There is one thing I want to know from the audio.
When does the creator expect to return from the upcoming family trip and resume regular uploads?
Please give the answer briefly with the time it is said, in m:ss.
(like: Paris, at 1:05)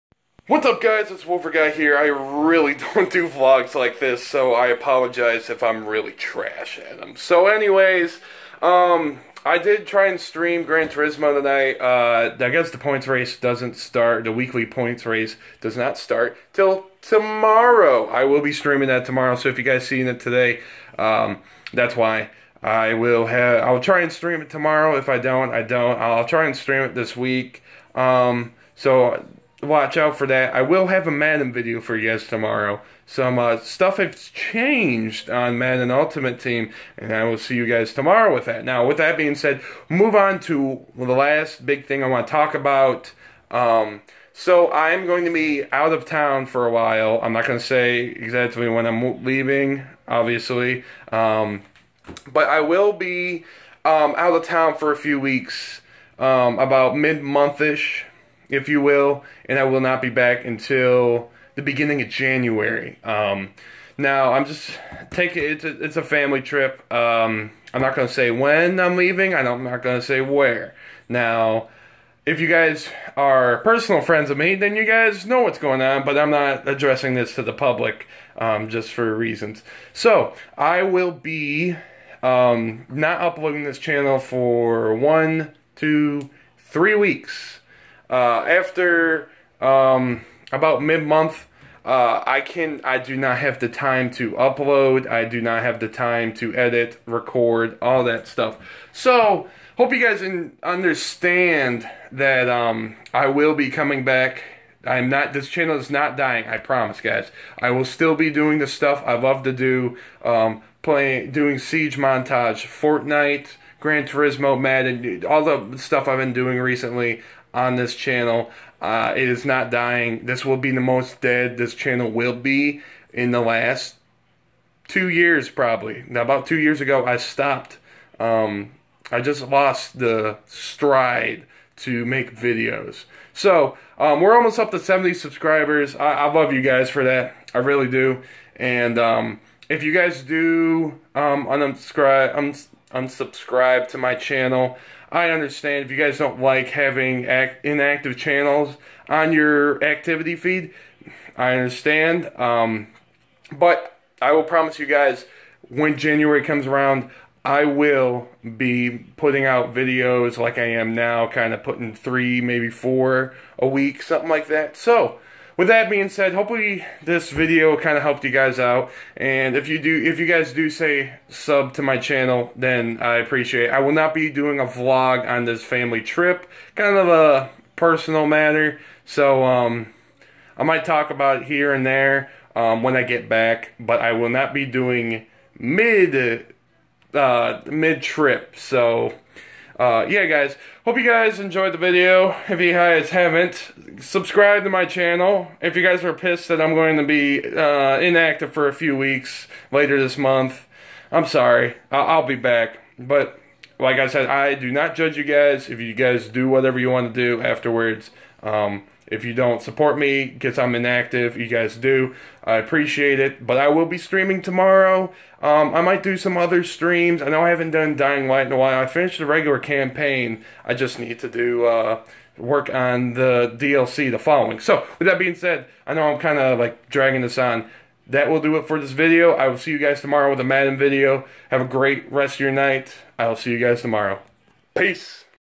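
beginning of January, at 1:01.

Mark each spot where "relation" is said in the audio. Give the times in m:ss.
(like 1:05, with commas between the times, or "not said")
not said.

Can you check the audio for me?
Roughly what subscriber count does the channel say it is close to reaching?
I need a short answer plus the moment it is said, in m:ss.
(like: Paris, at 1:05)
70, at 2:14.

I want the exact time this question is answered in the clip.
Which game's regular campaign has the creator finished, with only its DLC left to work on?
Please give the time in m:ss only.
3:37.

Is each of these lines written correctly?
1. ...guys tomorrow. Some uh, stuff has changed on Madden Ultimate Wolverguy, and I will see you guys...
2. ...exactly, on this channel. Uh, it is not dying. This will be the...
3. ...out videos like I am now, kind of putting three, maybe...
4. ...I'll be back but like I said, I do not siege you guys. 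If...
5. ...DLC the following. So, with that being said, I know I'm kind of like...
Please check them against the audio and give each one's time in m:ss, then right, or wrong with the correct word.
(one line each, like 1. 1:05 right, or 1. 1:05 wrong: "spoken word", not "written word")
1. 0:32 wrong: "Team", not "Wolverguy"
2. 1:56 wrong: "recently", not "exactly"
3. 2:39 right
4. 3:21 wrong: "judge", not "siege"
5. 3:43 right.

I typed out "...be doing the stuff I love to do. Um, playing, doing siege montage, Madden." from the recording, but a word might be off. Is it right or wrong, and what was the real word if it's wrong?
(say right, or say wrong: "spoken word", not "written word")
wrong: "Fortnite", not "Madden".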